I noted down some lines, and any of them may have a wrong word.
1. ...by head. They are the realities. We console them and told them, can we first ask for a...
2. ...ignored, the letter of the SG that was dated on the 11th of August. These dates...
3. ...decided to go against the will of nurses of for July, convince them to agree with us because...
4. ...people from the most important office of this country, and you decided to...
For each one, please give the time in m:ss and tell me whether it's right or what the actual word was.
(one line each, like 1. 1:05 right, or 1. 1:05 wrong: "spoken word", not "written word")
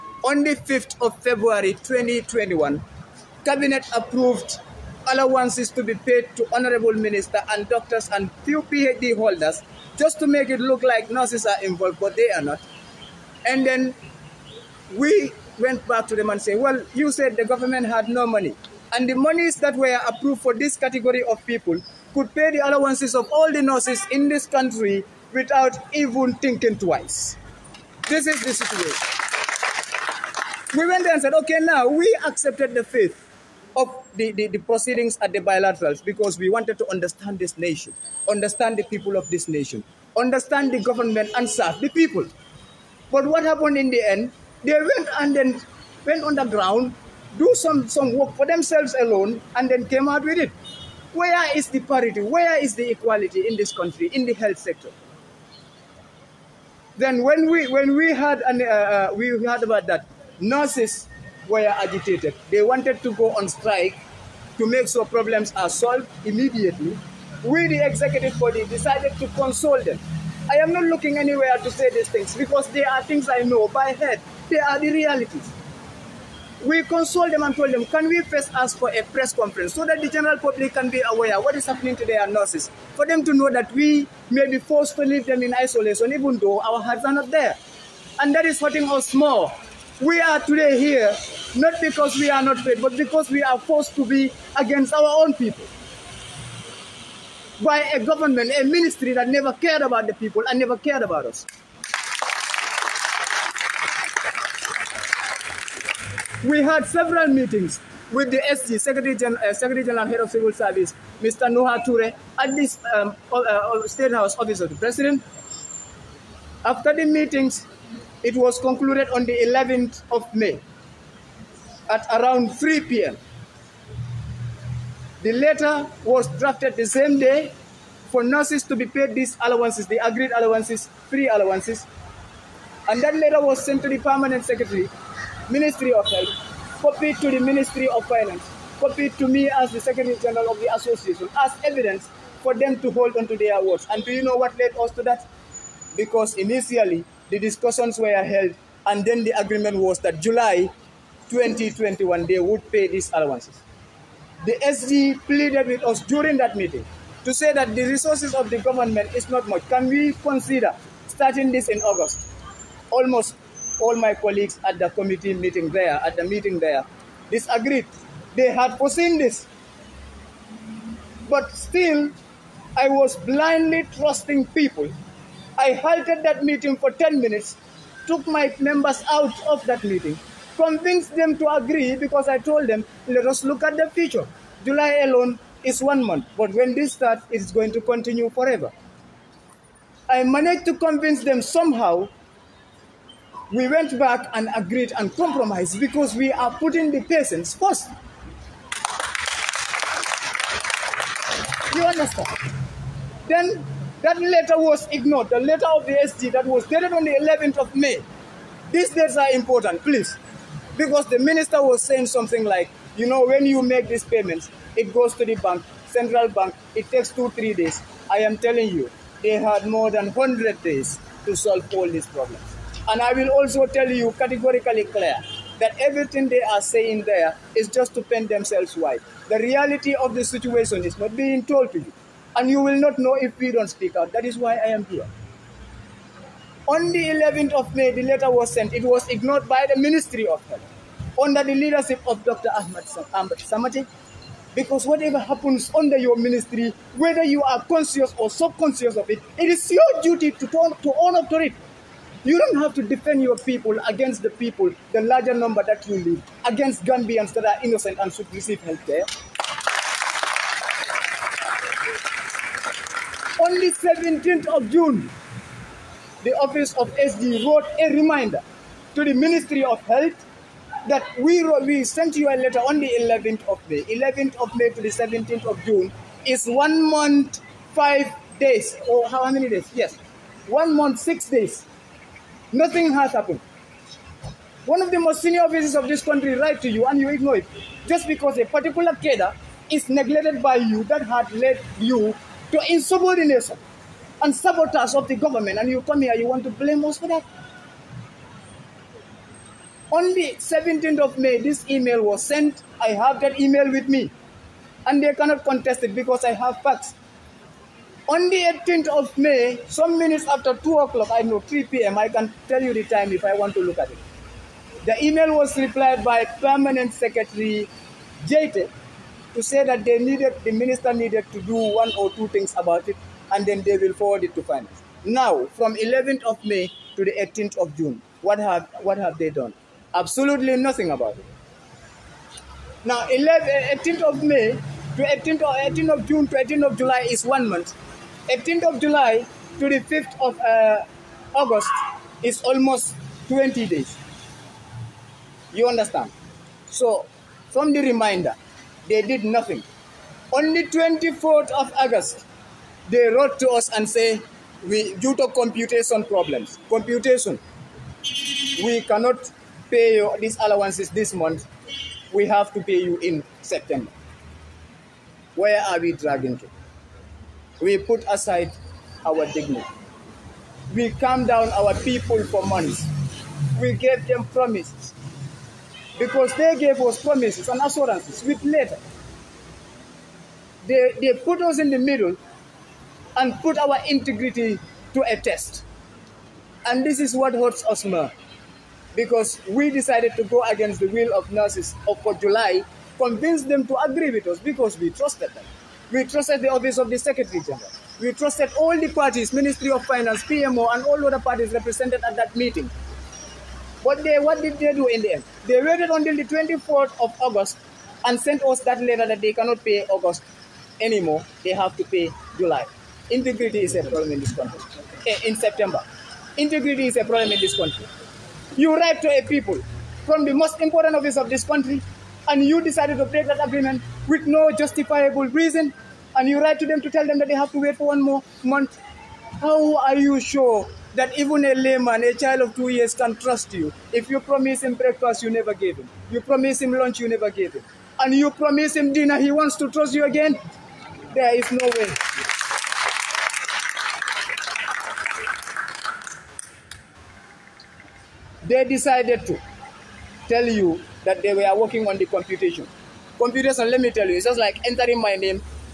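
1. 1:13 right
2. 3:24 wrong: "May", not "August"
3. 6:29 right
4. 6:59 right.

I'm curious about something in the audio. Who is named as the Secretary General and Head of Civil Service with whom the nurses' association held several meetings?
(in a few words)
Nuha Touray.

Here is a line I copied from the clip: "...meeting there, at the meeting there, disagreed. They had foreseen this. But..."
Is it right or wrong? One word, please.
right.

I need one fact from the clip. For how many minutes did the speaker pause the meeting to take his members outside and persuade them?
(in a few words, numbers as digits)
10.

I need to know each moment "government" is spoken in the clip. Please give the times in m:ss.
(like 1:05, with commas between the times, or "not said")
0:17, 0:40, 1:38, 2:38, 4:55.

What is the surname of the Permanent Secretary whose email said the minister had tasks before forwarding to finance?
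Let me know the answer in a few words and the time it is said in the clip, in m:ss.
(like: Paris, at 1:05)
Jate, at 5:18.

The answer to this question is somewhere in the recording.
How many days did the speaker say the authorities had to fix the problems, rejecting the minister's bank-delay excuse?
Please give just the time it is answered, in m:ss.
3:39.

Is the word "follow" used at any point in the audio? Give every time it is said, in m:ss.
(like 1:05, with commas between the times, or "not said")
not said.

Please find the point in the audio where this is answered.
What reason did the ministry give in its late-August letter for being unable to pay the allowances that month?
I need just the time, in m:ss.
5:55.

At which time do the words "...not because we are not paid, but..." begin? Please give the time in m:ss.
1:31.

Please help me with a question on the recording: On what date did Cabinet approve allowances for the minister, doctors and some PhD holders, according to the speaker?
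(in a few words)
5 February 2021.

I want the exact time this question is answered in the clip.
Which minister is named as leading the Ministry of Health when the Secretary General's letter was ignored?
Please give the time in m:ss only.
4:02.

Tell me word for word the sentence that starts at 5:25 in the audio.
Now, from 11th of May to the 18th of June, what have, what have they done?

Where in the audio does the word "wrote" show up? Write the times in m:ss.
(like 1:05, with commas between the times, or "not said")
4:27, 5:53.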